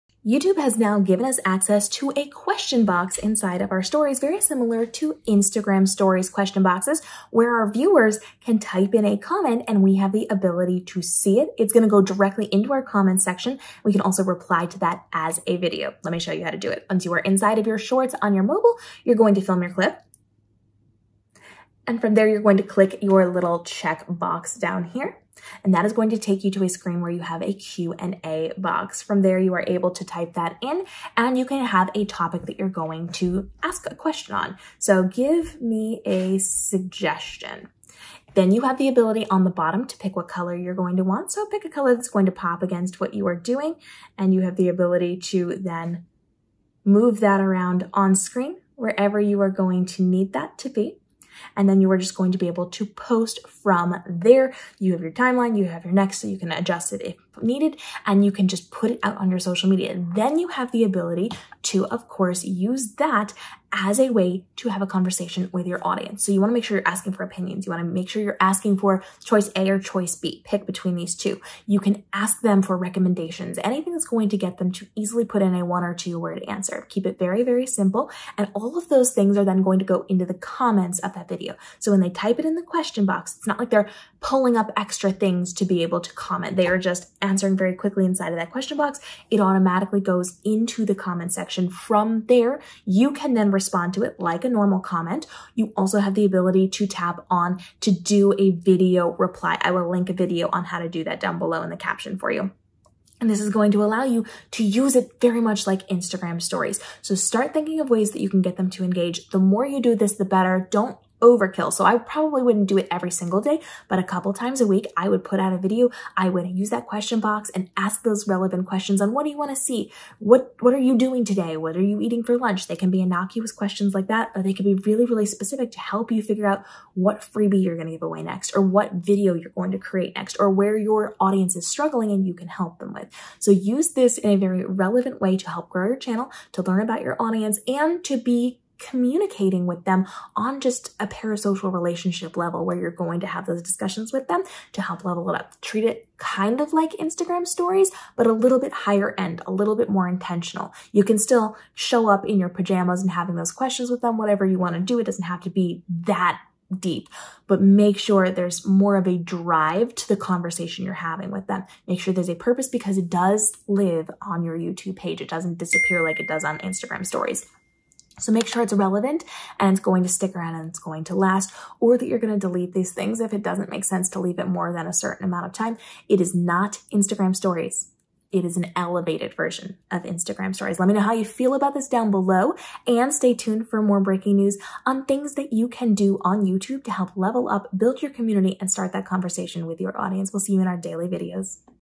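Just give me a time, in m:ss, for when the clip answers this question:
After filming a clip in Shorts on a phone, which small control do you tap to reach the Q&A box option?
0:23.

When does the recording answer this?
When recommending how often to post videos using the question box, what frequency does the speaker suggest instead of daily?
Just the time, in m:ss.
1:53.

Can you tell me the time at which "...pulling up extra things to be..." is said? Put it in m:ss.
1:24.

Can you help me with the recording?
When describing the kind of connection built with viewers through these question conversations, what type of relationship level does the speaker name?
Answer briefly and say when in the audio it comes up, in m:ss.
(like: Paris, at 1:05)
parasocial, at 2:21.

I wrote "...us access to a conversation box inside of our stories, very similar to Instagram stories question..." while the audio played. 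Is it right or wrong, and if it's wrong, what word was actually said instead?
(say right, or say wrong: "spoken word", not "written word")
wrong: "question", not "conversation".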